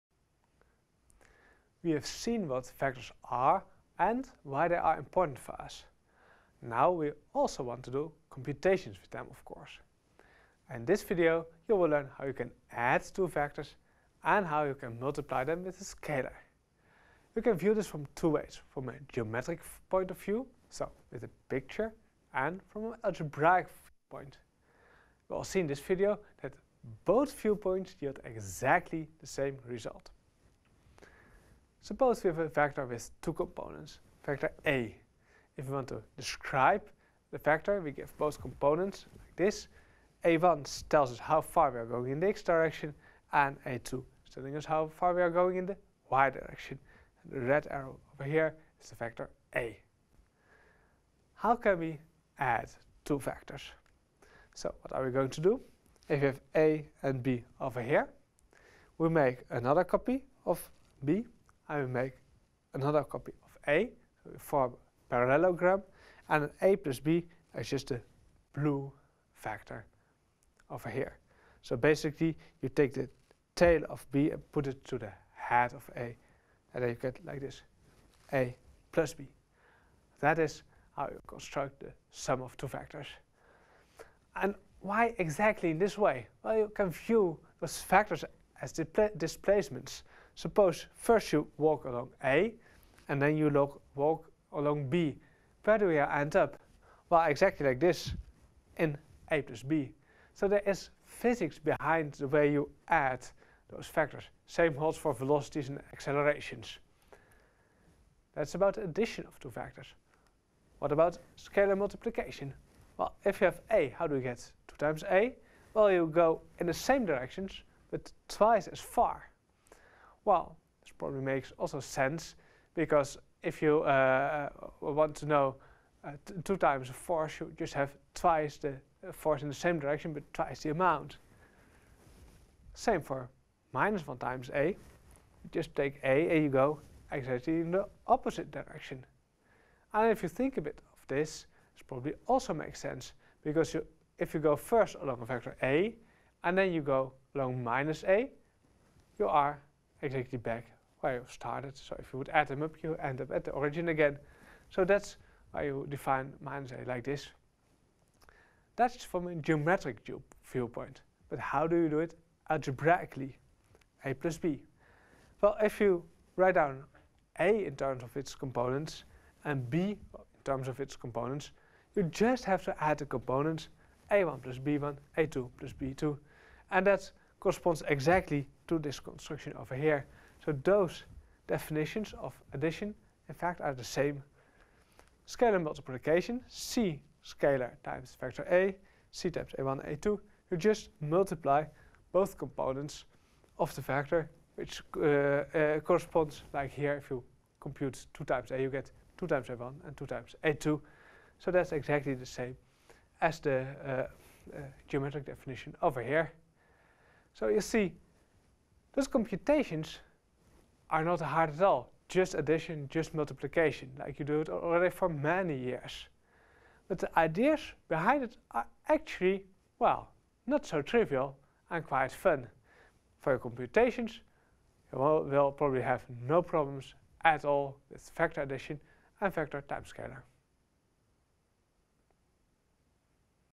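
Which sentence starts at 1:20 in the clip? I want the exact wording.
That is how you construct the sum of two vectors.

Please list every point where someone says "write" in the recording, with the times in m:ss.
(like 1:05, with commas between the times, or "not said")
2:46.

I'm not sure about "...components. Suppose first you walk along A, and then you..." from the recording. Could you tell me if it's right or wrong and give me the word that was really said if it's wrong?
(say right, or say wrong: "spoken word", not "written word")
wrong: "displacements", not "components".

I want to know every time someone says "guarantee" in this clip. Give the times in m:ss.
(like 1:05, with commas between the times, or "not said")
not said.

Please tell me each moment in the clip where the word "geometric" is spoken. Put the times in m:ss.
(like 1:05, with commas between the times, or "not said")
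0:19, 2:39, 3:24.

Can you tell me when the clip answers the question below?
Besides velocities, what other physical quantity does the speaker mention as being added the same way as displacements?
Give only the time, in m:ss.
1:45.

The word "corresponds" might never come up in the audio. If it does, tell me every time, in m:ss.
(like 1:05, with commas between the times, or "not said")
2:57, 3:15.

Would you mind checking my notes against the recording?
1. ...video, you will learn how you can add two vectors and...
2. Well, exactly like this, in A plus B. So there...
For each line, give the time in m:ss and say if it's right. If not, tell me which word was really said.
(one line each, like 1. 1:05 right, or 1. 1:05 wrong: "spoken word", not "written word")
1. 0:11 right
2. 1:37 right.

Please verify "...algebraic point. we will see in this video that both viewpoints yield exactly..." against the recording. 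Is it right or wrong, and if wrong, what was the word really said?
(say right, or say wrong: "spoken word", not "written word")
right.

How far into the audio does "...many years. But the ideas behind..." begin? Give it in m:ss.
3:35.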